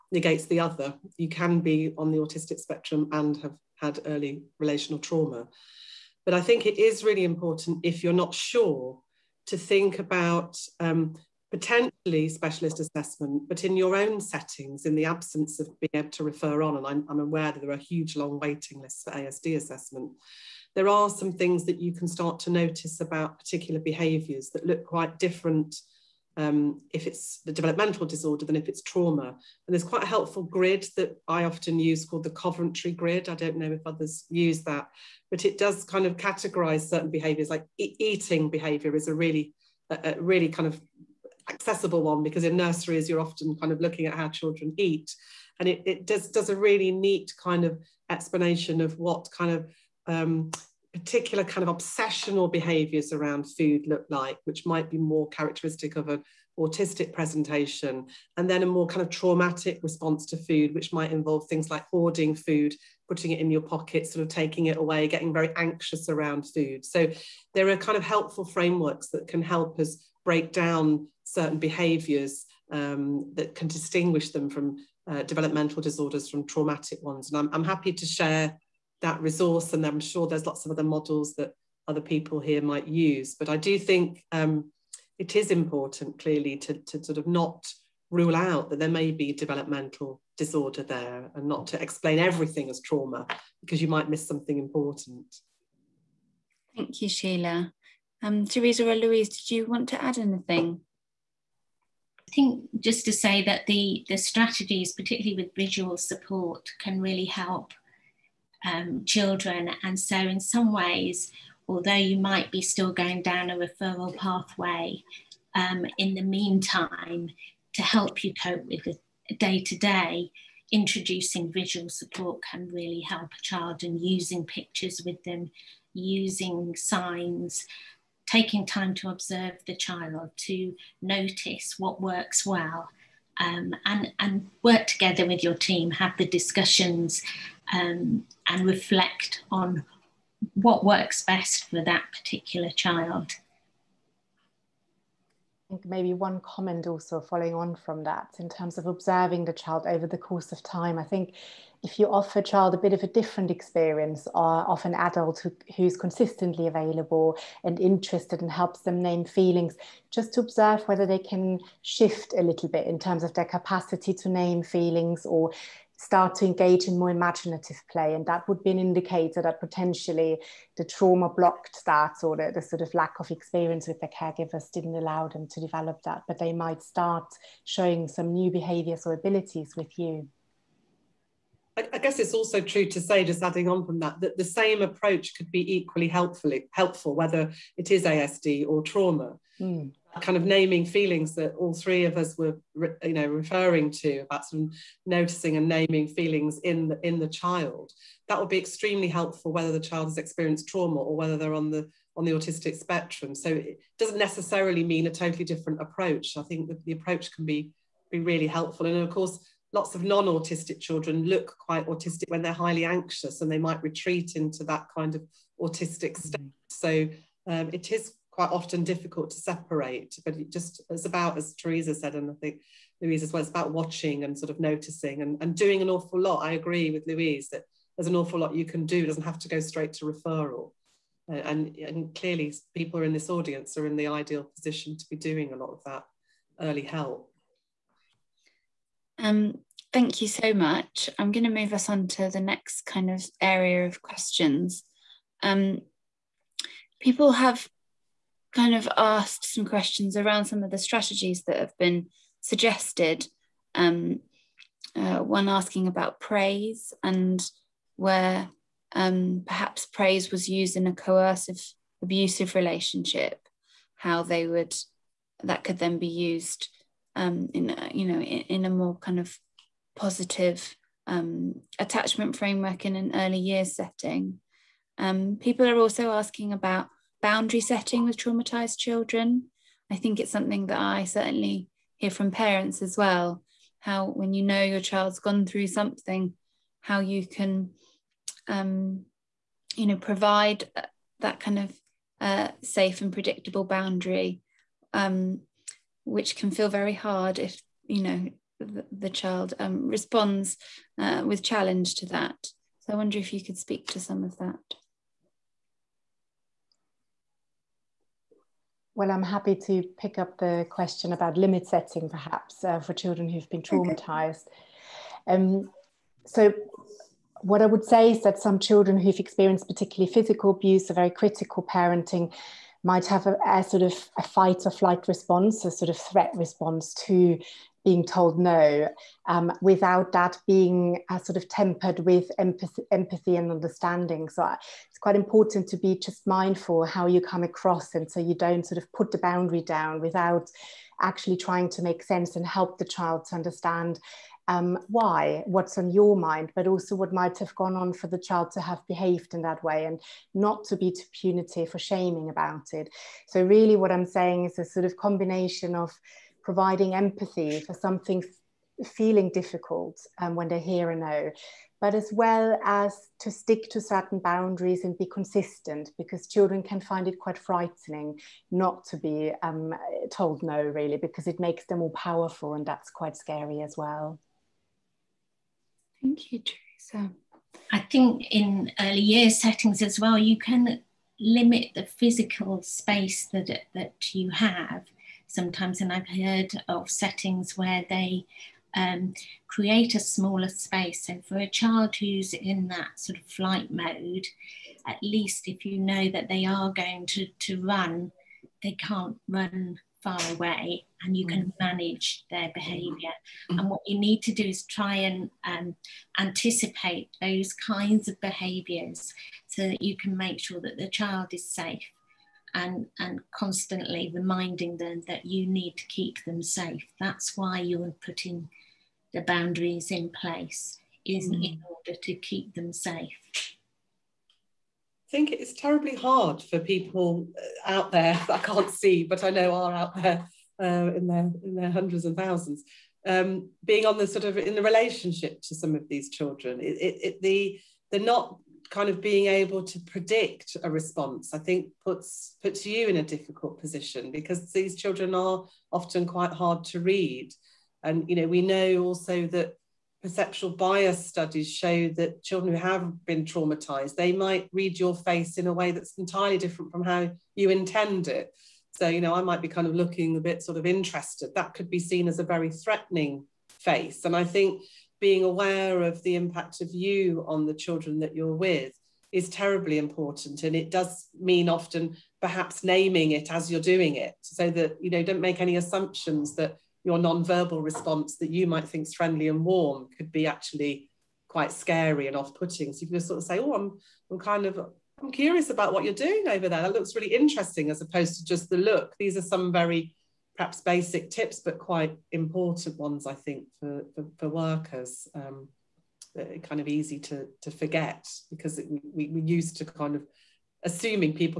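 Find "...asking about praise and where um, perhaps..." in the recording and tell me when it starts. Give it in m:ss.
4:15.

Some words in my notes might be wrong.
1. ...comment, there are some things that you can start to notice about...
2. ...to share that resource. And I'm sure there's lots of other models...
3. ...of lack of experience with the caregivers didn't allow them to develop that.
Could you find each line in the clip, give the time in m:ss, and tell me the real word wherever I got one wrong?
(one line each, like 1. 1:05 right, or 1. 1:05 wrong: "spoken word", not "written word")
1. 0:19 wrong: "assessment", not "comment"
2. 1:17 right
3. 2:52 right.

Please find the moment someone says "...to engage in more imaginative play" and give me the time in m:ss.
2:46.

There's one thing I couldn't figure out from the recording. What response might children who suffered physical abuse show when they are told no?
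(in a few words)
Fight or flight.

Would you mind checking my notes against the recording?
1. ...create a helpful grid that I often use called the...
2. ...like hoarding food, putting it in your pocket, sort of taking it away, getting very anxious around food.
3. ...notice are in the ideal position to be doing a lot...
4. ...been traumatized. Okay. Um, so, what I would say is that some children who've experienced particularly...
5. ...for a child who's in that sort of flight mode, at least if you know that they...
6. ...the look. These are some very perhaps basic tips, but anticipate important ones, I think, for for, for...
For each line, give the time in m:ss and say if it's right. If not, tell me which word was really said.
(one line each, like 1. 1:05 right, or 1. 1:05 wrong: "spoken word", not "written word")
1. 0:29 wrong: "quite", not "create"
2. 1:01 right
3. 3:53 wrong: "audience", not "notice"
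4. 5:13 right
5. 6:31 right
6. 8:08 wrong: "quite", not "anticipate".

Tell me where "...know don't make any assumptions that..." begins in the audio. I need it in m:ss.
7:54.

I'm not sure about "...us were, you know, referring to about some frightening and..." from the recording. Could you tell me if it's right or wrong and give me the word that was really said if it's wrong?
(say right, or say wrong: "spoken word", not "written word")
wrong: "noticing", not "frightening".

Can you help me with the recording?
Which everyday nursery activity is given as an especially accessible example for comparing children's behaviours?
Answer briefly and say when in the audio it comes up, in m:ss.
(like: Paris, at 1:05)
Eating, at 0:37.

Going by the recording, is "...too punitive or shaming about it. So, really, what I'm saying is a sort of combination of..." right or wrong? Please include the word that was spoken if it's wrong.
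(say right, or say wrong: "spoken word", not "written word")
right.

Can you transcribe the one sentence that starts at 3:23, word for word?
So it doesn't necessarily mean a totally different approach.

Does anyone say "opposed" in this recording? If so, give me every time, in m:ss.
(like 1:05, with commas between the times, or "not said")
8:07.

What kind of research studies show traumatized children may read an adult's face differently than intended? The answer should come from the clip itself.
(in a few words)
Perceptual bias studies.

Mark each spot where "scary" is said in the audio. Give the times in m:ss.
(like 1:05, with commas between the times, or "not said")
6:13, 8:01.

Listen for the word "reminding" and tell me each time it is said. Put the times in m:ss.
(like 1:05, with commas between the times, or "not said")
6:54.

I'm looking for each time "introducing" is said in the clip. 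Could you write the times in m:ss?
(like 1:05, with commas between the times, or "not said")
2:00.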